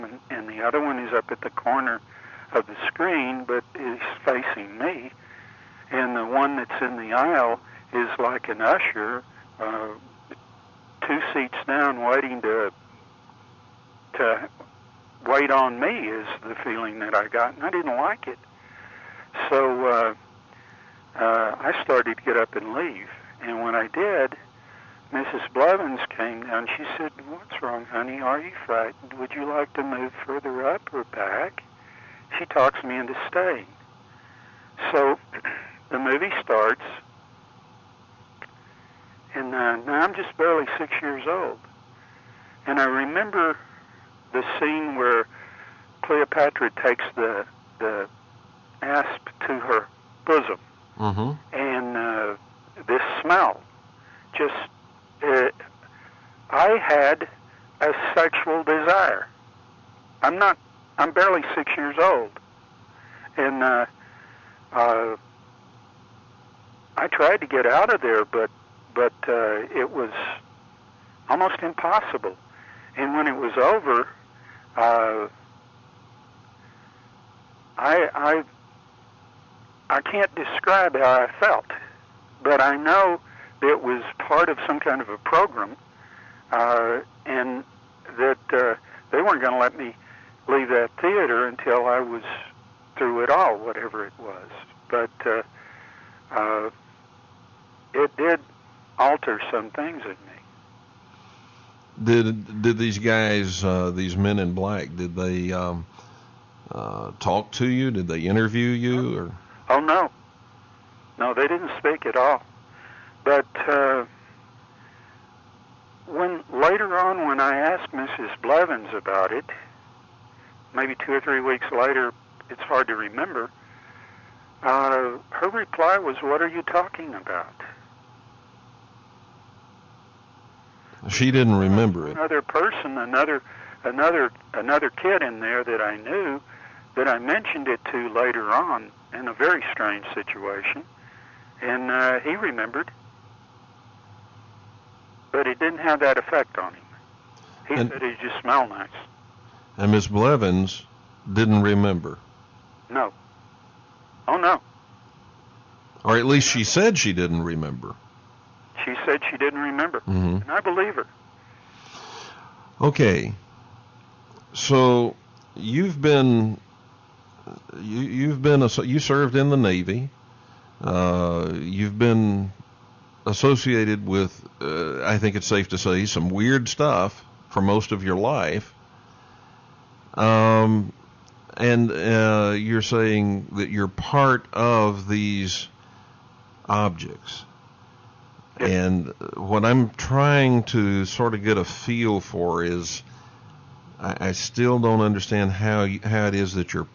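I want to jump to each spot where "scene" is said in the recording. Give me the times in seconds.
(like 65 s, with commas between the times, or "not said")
44 s.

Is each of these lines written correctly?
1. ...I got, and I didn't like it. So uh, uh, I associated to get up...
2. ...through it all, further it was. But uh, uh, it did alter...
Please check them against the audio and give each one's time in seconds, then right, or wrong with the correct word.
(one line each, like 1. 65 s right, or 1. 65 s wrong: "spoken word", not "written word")
1. 17 s wrong: "started", not "associated"
2. 92 s wrong: "whatever", not "further".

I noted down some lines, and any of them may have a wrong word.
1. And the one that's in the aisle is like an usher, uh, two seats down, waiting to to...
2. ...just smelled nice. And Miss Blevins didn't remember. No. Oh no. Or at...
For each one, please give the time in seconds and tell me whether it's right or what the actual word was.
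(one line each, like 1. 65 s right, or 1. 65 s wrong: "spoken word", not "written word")
1. 5 s right
2. 148 s right.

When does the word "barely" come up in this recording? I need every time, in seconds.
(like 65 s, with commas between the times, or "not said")
40 s, 61 s.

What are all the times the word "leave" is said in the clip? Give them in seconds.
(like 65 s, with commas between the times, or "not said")
22 s, 90 s.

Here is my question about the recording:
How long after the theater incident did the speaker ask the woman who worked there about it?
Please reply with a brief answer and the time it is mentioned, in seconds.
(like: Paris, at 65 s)
2 or 3 weeks, at 121 s.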